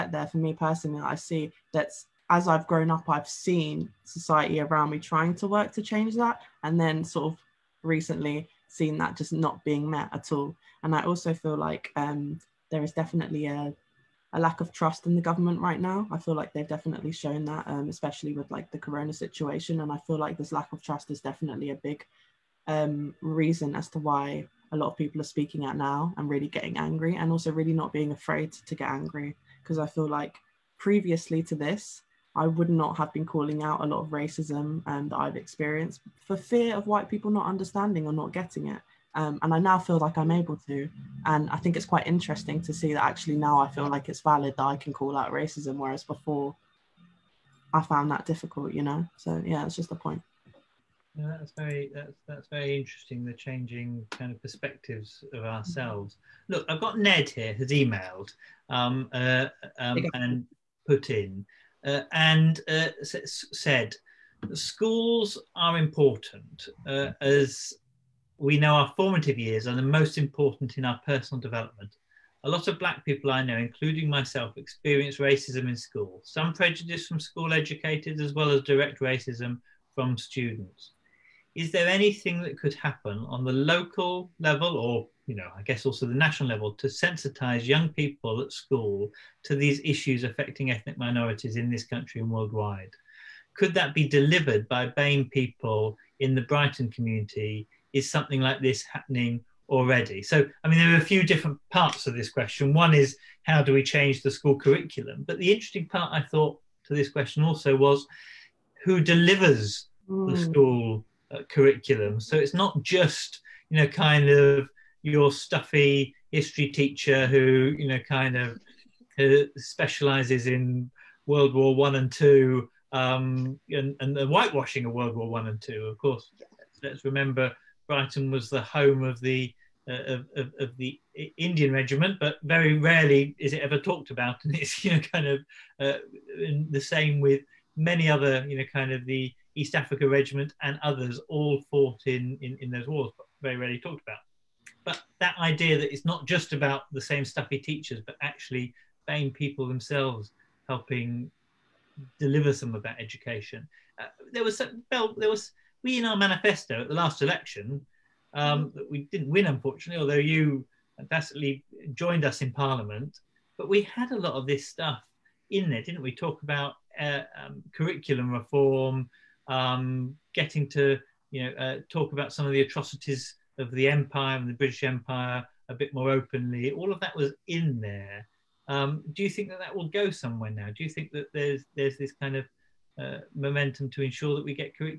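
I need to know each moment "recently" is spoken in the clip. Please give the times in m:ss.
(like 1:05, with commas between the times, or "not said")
0:07.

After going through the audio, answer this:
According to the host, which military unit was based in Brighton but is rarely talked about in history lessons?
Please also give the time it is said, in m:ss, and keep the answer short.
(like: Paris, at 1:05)
The Indian regiment, at 2:11.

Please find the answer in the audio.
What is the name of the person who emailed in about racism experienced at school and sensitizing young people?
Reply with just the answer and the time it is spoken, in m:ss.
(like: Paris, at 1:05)
Ned, at 0:56.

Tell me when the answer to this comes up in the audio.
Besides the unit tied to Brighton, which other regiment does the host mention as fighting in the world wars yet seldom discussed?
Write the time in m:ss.
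2:19.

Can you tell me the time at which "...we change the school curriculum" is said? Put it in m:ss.
1:43.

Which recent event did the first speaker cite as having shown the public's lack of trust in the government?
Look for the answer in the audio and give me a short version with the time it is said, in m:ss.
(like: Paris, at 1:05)
Corona, at 0:18.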